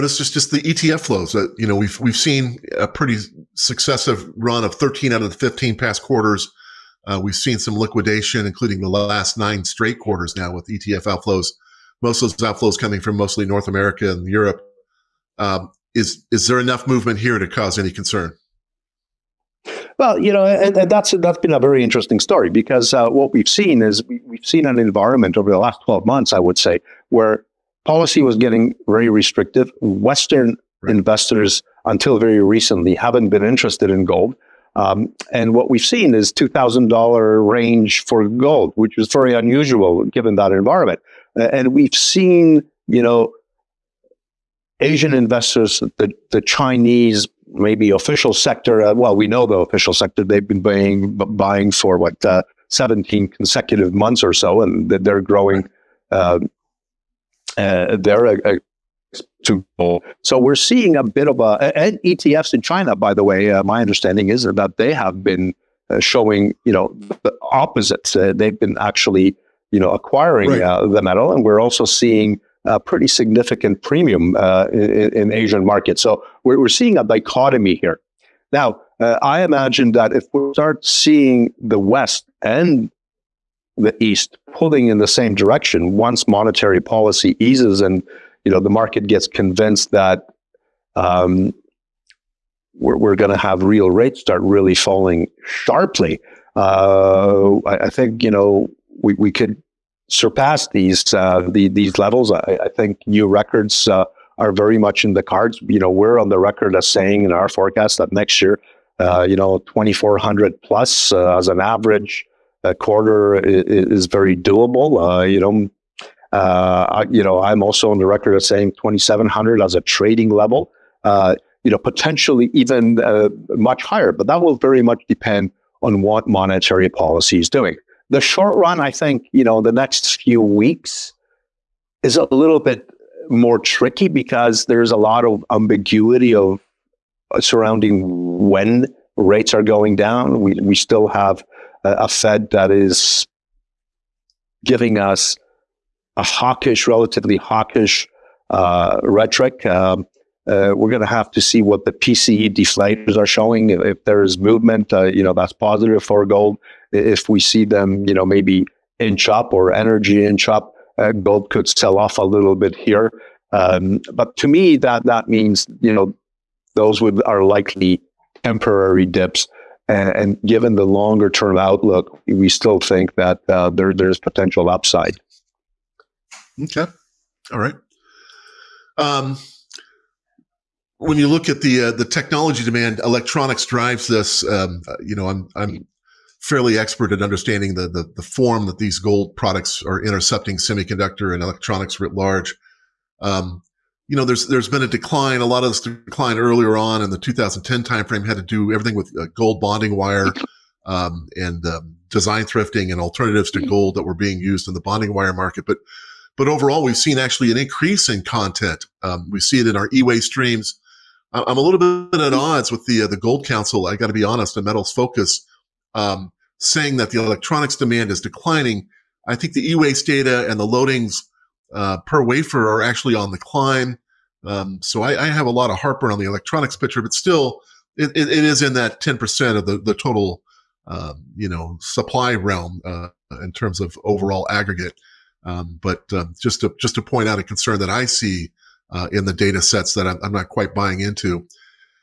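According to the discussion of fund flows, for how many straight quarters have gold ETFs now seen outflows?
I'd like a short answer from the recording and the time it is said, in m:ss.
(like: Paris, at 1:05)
9, at 0:09.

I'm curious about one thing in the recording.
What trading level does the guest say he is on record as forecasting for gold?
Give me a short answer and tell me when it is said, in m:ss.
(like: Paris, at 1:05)
2,700, at 1:58.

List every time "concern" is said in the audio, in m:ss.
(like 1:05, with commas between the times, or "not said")
0:17, 3:57.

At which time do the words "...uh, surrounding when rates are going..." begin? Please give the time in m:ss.
2:17.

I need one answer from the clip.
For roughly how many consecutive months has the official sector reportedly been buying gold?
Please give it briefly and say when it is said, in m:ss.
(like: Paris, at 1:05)
17, at 0:52.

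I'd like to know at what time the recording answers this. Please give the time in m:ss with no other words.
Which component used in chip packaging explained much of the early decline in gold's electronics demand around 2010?
3:19.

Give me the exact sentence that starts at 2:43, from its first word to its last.
Um, but to me, that that means you know those would are likely temporary dips.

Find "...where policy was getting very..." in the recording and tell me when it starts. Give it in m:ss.
0:27.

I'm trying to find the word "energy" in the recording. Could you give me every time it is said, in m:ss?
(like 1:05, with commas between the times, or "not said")
2:39.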